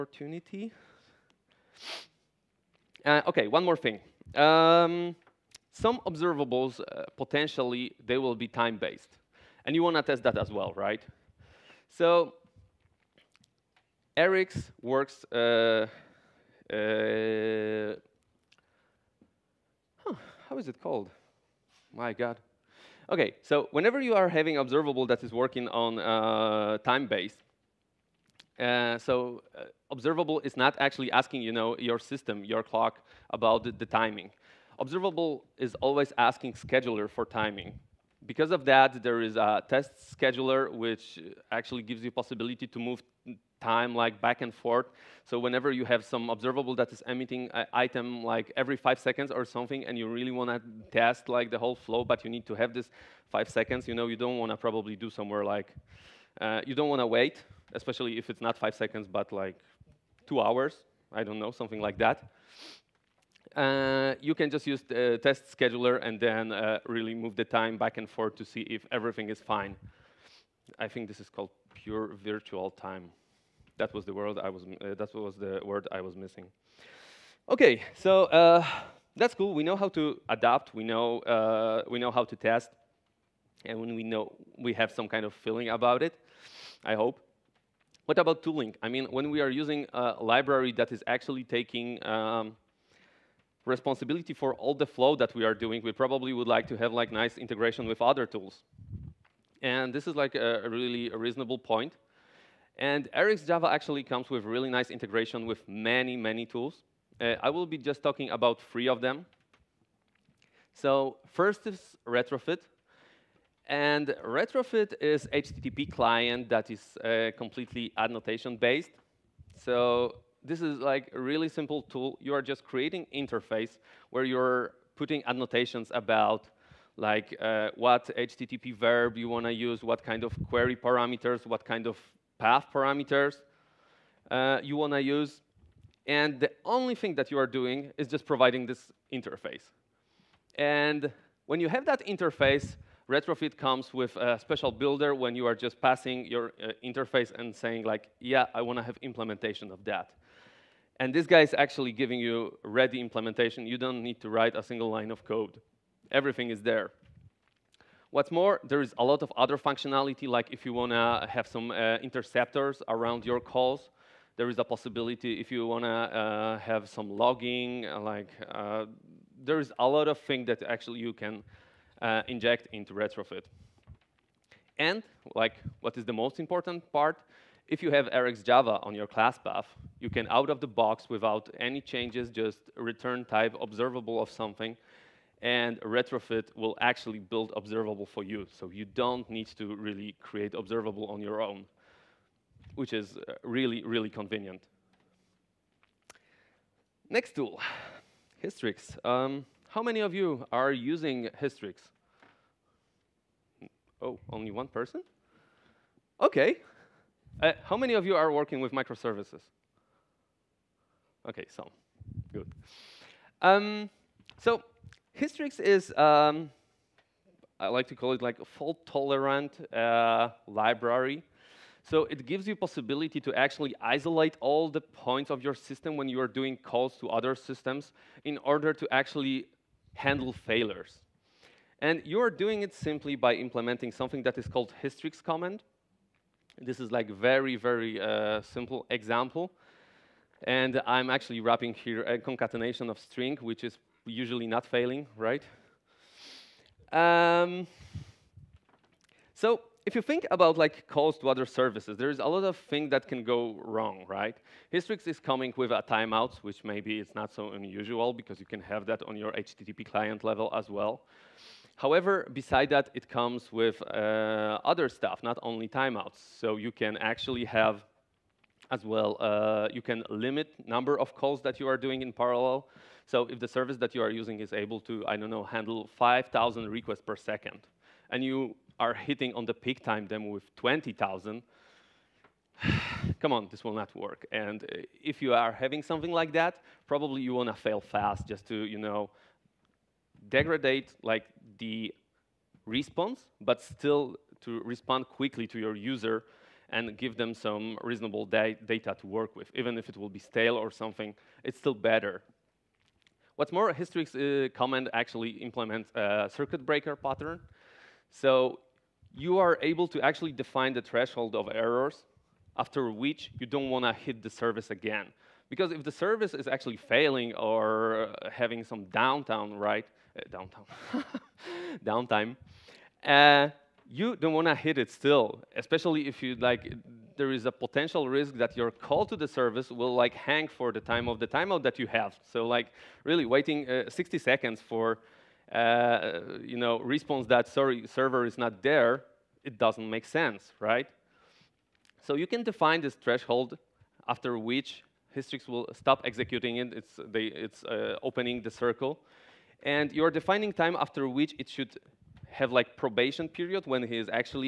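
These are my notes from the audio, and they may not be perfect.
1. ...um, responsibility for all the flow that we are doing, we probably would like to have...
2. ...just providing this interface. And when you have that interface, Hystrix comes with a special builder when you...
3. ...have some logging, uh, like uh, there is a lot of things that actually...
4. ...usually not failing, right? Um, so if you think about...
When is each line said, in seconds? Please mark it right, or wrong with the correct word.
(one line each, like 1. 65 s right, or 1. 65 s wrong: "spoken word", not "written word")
1. 92 s right
2. 138 s wrong: "Retrofit", not "Hystrix"
3. 166 s right
4. 244 s right.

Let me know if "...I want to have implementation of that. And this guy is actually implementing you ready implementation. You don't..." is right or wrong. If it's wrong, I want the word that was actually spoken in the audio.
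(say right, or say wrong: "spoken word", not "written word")
wrong: "giving", not "implementing".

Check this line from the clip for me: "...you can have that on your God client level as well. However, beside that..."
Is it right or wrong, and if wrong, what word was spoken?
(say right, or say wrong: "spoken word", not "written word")
wrong: "HTTP", not "God".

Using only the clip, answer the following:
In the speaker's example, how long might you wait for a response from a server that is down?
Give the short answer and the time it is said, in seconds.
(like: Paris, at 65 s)
60 seconds, at 333 s.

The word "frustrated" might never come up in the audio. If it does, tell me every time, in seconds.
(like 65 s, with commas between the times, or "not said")
not said.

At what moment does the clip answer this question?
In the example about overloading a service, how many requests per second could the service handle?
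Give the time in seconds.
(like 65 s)
275 s.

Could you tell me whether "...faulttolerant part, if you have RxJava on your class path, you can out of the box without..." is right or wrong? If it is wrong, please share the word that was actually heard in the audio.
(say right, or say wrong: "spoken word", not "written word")
wrong: "important", not "faulttolerant".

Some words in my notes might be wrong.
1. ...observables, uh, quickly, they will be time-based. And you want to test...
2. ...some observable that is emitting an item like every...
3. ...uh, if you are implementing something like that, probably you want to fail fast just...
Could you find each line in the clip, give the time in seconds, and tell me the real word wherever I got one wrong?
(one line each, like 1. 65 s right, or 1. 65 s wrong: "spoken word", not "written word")
1. 6 s wrong: "potentially", not "quickly"
2. 46 s right
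3. 284 s wrong: "having", not "implementing".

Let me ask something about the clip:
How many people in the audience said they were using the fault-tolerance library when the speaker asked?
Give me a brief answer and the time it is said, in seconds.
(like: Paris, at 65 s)
1, at 204 s.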